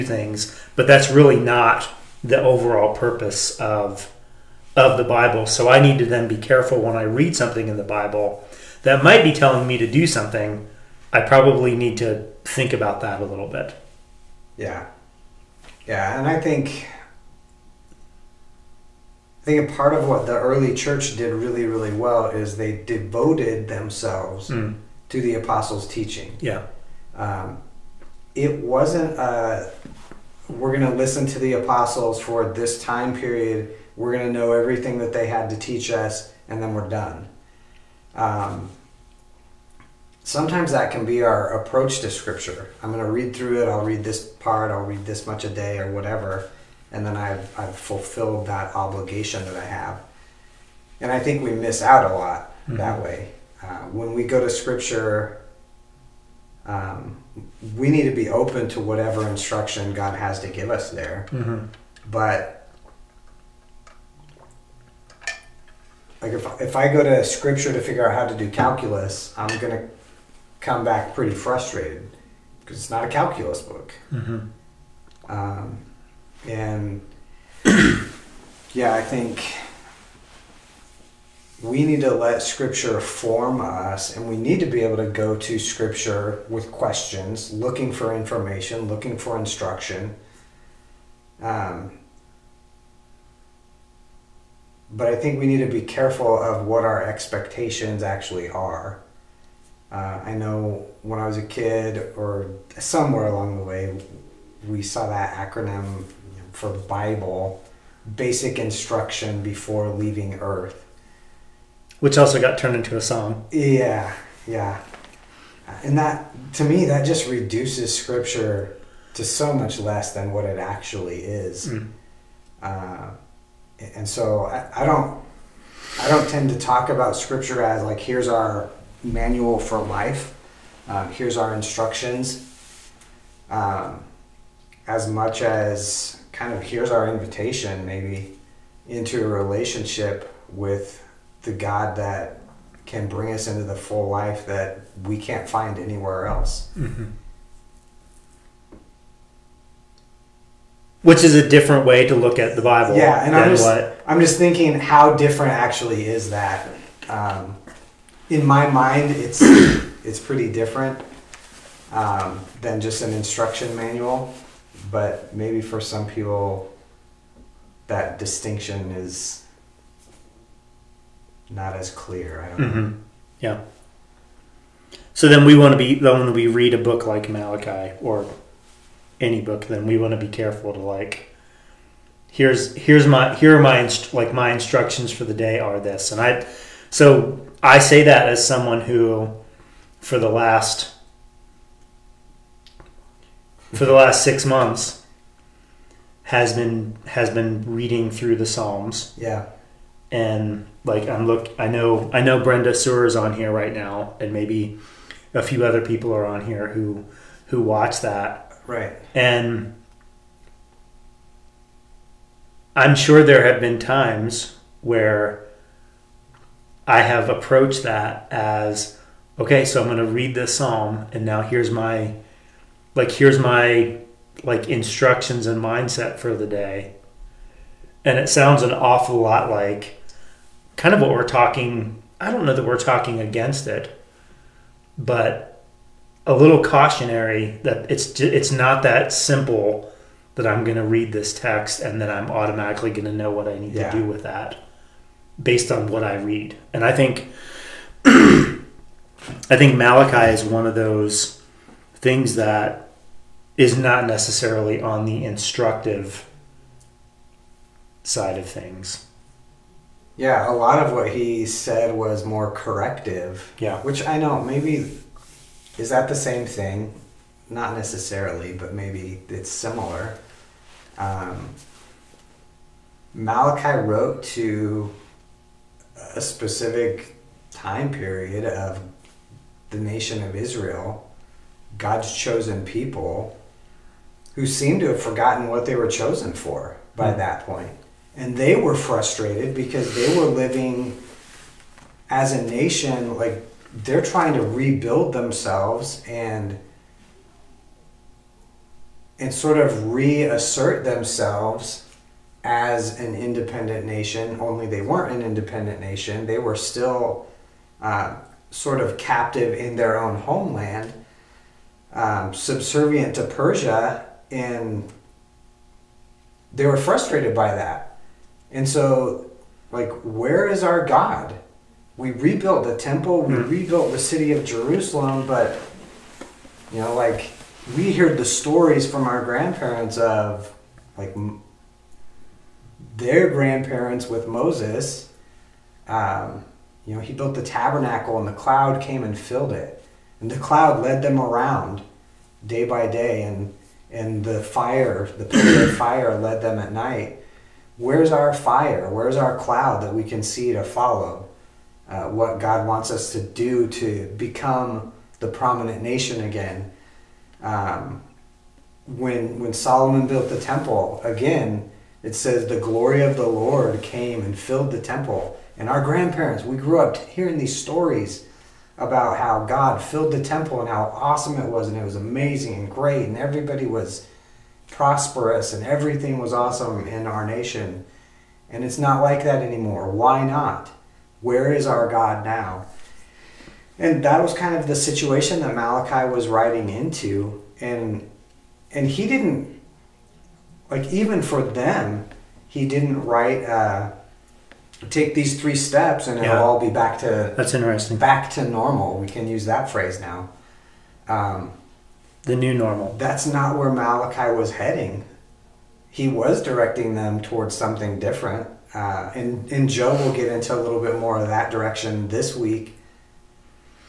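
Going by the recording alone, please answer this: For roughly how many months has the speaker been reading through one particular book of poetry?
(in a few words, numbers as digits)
6.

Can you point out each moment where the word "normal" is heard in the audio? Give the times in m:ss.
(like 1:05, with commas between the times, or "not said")
6:38, 6:42.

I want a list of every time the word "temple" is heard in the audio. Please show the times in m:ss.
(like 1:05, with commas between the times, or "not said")
5:22, 6:00, 6:04, 6:10.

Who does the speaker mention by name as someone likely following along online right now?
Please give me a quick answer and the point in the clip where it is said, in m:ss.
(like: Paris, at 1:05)
Brenda Sewer, at 3:22.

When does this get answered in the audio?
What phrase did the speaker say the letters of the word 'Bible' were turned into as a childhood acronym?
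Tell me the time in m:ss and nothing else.
1:48.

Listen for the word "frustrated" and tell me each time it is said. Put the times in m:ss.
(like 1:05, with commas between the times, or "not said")
1:11, 4:48, 5:16.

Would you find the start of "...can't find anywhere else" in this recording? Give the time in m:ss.
2:25.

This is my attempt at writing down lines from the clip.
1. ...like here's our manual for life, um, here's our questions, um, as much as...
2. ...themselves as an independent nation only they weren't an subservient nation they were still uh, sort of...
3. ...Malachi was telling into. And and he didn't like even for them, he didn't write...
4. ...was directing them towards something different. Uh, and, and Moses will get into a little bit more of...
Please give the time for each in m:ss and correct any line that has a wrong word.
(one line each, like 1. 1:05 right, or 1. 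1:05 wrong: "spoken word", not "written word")
1. 2:07 wrong: "instructions", not "questions"
2. 5:00 wrong: "independent", not "subservient"
3. 6:25 wrong: "writing", not "telling"
4. 6:46 wrong: "Joe", not "Moses".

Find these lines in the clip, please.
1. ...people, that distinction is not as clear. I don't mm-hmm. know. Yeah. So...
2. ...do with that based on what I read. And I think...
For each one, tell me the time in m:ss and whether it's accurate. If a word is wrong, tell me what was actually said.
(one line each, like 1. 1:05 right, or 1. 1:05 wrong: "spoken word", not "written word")
1. 2:46 right
2. 4:03 right.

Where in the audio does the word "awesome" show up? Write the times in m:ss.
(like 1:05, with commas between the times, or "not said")
6:10, 6:16.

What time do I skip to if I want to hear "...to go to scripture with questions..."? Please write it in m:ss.
1:24.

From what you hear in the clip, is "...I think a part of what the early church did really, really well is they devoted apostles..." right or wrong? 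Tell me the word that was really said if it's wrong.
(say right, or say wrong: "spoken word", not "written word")
wrong: "themselves", not "apostles".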